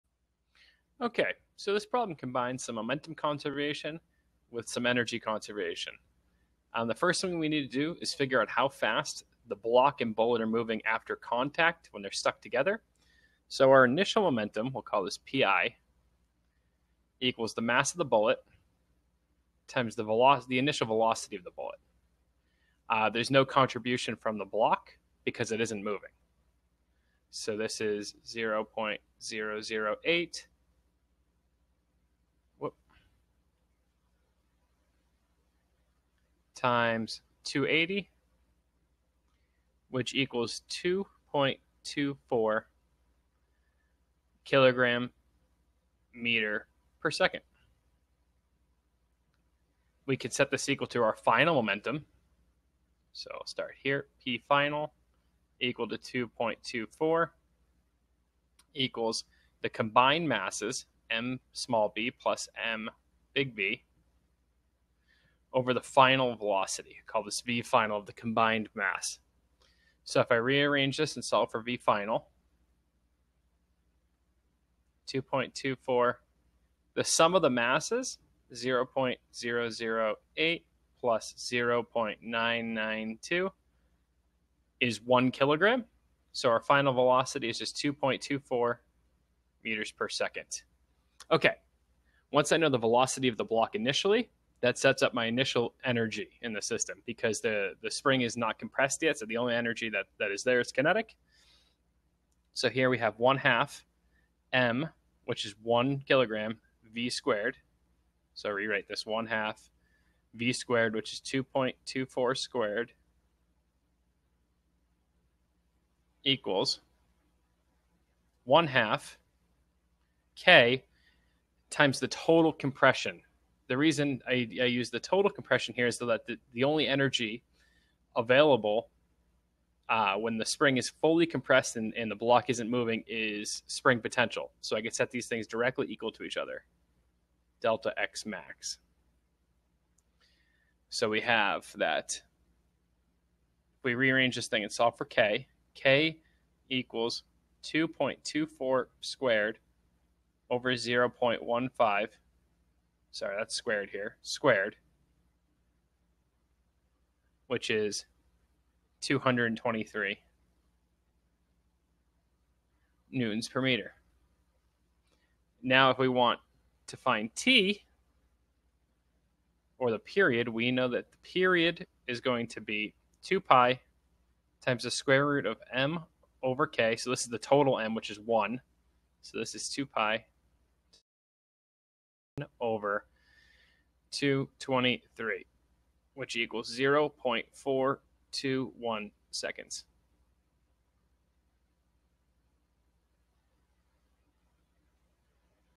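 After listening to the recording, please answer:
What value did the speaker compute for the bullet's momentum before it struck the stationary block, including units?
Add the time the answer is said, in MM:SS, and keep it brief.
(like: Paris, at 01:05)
2.24 kg·m/s, at 00:40.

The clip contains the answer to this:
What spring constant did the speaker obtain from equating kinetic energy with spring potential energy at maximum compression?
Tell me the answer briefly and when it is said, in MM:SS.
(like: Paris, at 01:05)
223 N/m, at 02:39.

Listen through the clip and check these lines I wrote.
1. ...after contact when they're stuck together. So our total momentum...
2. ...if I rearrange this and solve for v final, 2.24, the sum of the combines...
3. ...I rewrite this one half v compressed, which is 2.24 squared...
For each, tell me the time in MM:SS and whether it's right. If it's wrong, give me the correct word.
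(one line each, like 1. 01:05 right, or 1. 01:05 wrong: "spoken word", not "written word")
1. 00:10 wrong: "initial", not "total"
2. 01:10 wrong: "masses", not "combines"
3. 01:48 wrong: "squared", not "compressed".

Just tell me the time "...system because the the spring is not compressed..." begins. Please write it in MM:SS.
01:36.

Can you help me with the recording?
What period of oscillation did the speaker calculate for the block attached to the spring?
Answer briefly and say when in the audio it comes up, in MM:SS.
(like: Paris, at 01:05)
0.421 seconds, at 03:06.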